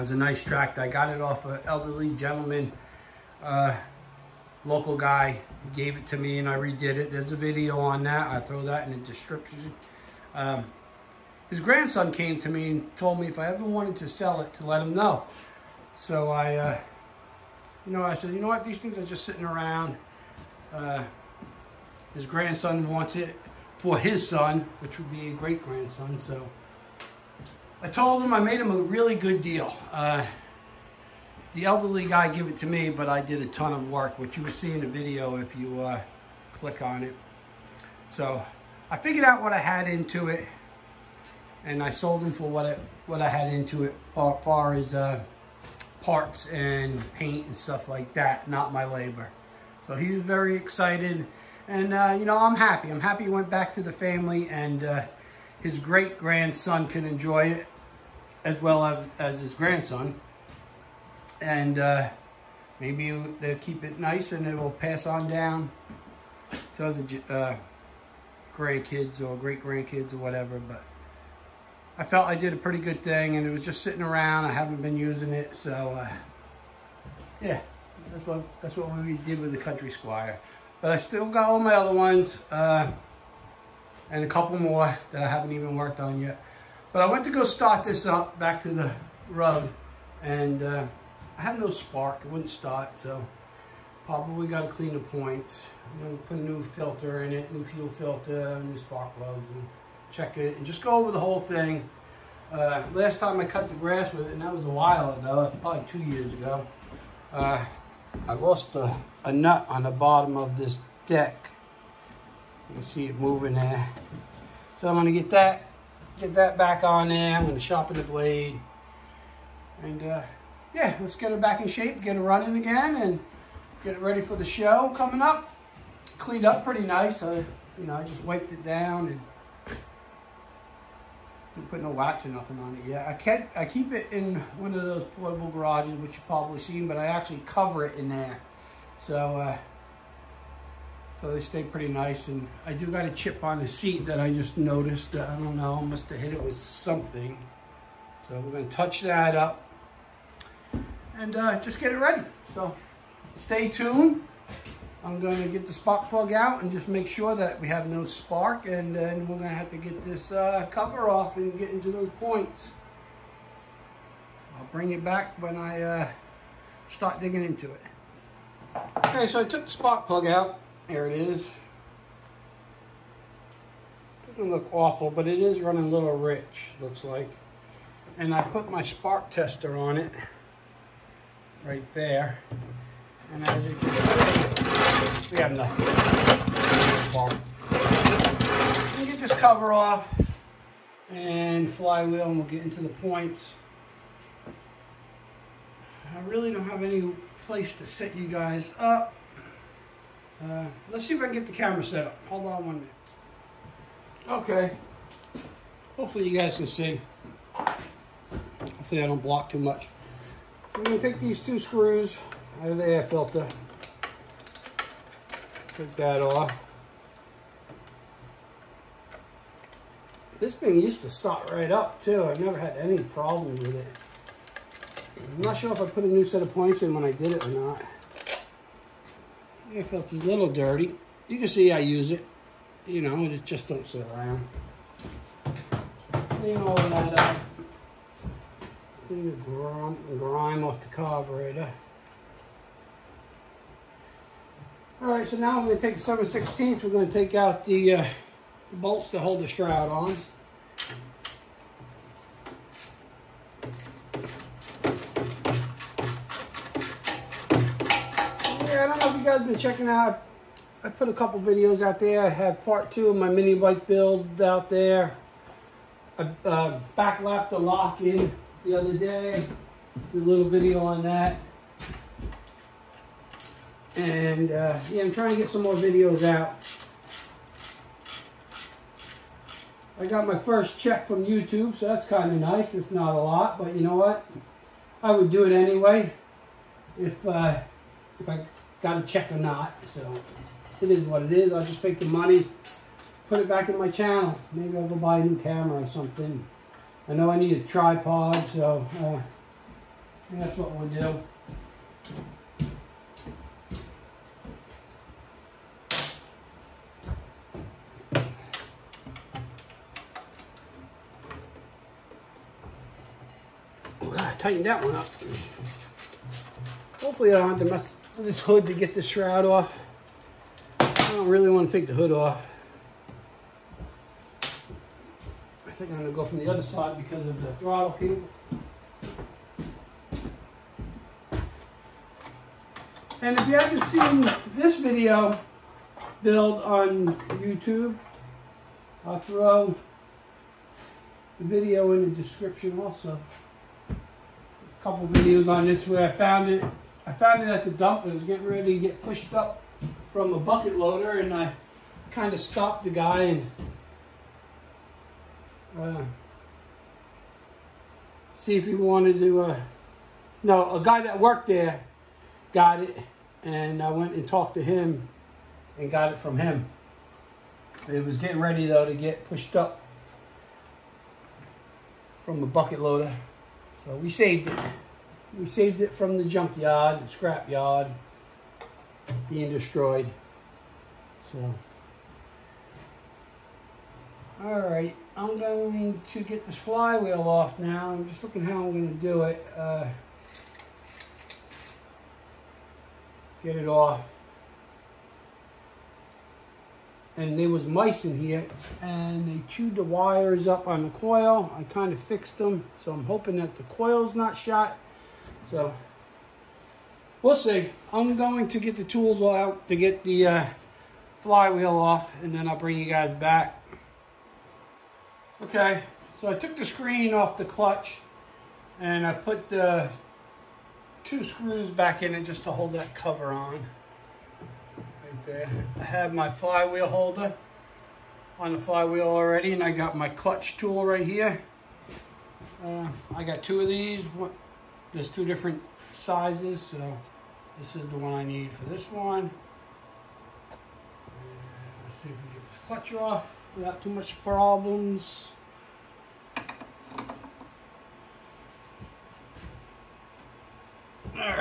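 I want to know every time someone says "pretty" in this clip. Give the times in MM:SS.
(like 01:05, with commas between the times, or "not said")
01:12, 02:06, 02:21.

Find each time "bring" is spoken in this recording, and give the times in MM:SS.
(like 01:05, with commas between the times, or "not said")
02:44, 06:52.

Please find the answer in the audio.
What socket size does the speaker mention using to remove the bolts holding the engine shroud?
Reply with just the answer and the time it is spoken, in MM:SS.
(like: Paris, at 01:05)
7/16, at 04:06.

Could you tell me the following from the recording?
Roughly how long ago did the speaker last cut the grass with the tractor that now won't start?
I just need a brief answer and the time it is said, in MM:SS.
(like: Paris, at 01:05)
2 years, at 01:45.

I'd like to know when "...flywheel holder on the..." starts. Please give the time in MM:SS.
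07:06.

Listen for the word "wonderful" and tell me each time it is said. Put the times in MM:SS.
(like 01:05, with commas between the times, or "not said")
not said.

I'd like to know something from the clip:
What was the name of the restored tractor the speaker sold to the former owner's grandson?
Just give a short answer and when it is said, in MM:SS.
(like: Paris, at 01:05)
Country Squire, at 01:19.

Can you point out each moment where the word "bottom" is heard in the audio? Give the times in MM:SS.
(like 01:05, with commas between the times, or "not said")
01:49.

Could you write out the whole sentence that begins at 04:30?
Did a little video on that.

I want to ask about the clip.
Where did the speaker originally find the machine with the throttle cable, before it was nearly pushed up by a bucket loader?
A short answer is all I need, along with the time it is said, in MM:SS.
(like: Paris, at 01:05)
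The dump, at 05:47.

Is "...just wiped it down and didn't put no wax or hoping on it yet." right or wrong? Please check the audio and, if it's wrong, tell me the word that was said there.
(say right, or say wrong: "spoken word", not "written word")
wrong: "nothing", not "hoping".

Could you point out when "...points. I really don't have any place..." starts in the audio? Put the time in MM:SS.
03:12.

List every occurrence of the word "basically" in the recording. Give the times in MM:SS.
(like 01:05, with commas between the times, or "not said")
not said.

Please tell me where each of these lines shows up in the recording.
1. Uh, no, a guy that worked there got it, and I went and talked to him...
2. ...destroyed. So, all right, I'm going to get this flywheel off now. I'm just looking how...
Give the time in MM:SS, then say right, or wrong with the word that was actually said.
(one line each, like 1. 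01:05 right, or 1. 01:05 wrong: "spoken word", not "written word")
1. 05:59 right
2. 06:19 right.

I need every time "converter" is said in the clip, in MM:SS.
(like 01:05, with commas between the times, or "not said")
not said.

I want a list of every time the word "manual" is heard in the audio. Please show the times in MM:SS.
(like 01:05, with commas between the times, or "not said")
not said.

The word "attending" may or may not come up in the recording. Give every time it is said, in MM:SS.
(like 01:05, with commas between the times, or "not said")
not said.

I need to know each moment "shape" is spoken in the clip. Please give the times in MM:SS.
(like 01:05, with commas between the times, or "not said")
02:01.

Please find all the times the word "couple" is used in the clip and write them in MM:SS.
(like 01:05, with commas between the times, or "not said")
01:24, 04:21, 05:44.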